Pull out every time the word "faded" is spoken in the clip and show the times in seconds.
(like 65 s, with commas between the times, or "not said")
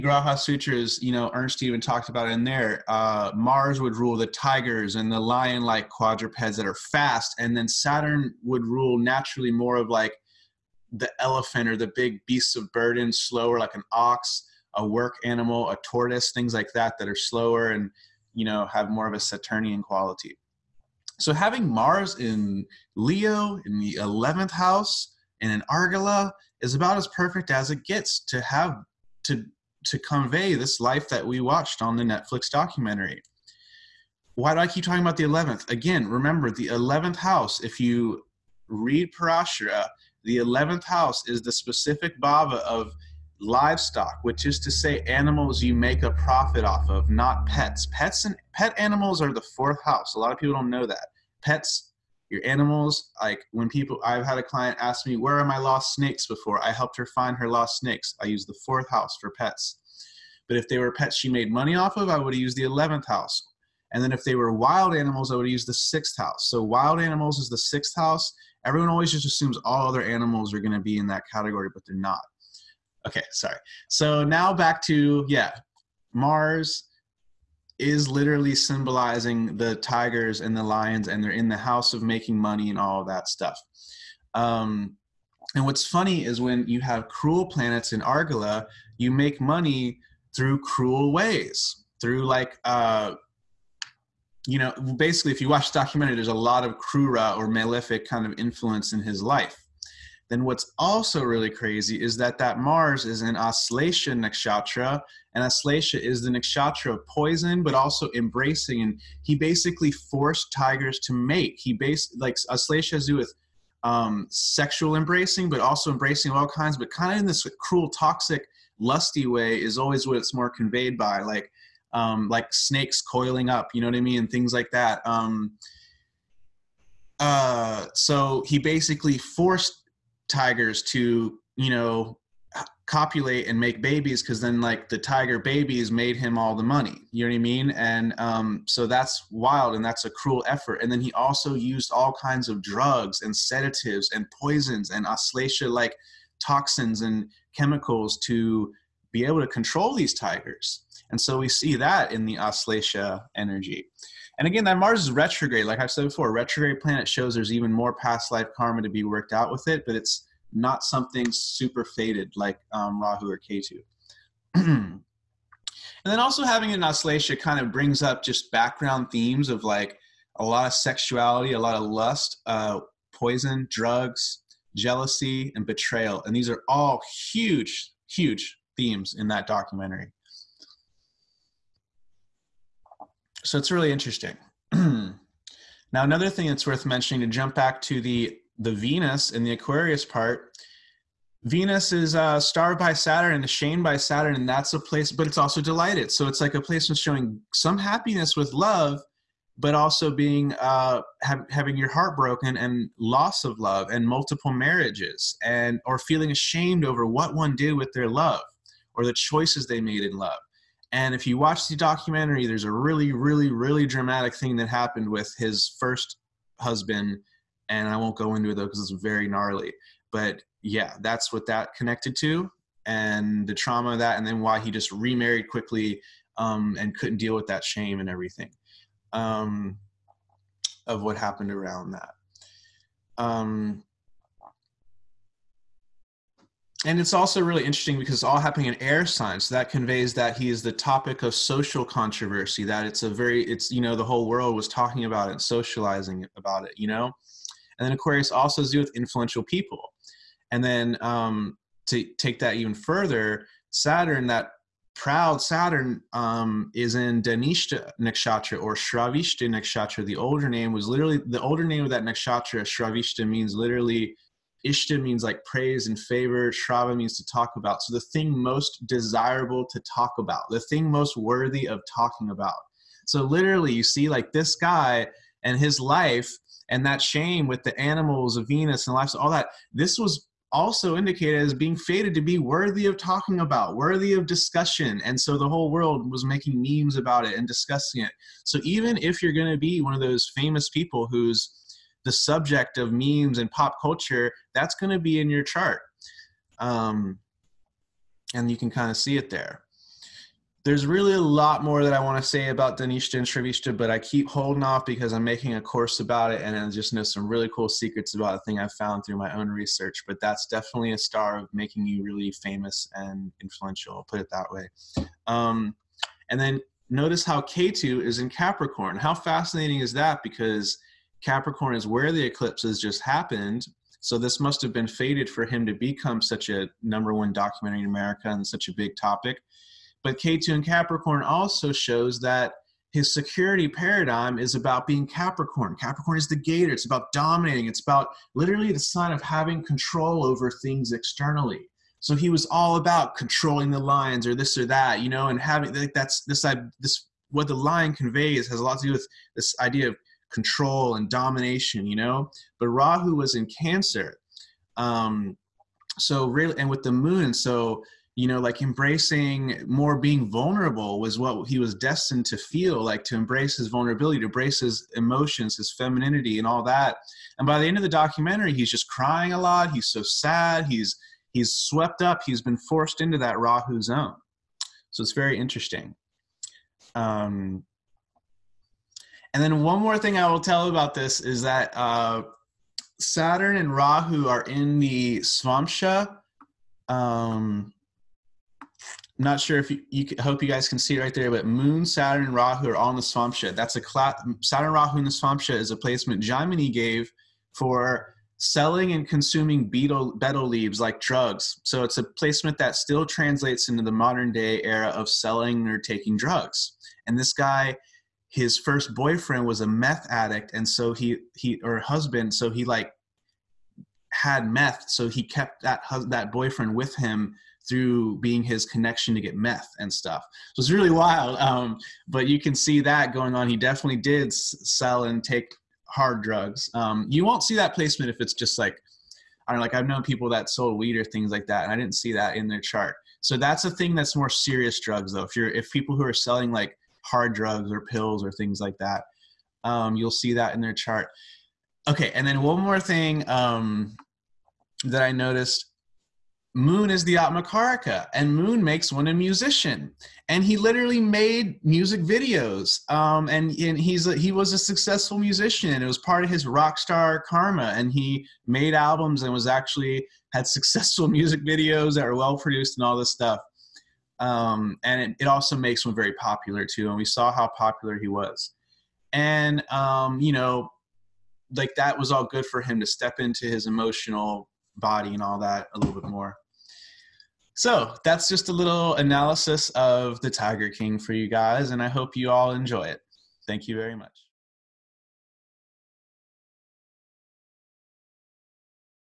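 161 s.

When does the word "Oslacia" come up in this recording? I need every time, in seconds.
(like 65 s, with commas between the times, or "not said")
152 s, 166 s.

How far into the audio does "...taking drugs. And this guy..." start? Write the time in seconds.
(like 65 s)
405 s.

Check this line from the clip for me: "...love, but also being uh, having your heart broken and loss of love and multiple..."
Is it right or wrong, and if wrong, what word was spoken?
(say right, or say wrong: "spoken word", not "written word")
right.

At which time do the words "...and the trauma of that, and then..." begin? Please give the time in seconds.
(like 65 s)
222 s.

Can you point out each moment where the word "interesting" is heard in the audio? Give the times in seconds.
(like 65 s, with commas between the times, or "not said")
183 s, 237 s, 375 s.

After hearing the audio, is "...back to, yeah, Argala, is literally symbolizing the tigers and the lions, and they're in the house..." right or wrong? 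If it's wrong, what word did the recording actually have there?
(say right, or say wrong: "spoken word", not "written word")
wrong: "Mars", not "Argala".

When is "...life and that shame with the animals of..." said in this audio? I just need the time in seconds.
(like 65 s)
275 s.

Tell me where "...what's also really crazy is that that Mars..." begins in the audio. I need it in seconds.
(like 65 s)
100 s.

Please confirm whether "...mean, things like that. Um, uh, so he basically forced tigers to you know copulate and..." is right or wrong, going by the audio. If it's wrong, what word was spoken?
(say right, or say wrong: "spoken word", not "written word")
right.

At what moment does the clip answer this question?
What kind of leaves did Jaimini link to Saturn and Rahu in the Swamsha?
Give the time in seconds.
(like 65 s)
400 s.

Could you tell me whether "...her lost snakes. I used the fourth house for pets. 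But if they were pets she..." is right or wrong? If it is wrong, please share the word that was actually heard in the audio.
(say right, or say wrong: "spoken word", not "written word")
right.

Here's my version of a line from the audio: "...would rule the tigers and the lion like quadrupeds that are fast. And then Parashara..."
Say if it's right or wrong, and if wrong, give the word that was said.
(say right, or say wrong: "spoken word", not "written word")
wrong: "Saturn", not "Parashara".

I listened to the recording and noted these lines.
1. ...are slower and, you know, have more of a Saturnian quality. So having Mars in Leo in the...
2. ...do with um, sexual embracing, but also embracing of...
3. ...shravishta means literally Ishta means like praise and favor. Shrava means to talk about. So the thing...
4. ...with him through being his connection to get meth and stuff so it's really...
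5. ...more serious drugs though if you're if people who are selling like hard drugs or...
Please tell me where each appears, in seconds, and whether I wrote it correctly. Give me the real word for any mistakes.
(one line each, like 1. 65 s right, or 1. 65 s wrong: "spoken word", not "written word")
1. 17 s right
2. 113 s right
3. 262 s right
4. 416 s right
5. 434 s right.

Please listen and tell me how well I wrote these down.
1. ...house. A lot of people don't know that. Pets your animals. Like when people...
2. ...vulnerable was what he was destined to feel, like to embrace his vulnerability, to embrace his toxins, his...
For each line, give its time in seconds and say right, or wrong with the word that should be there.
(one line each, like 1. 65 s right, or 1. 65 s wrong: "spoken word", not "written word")
1. 49 s right
2. 360 s wrong: "emotions", not "toxins".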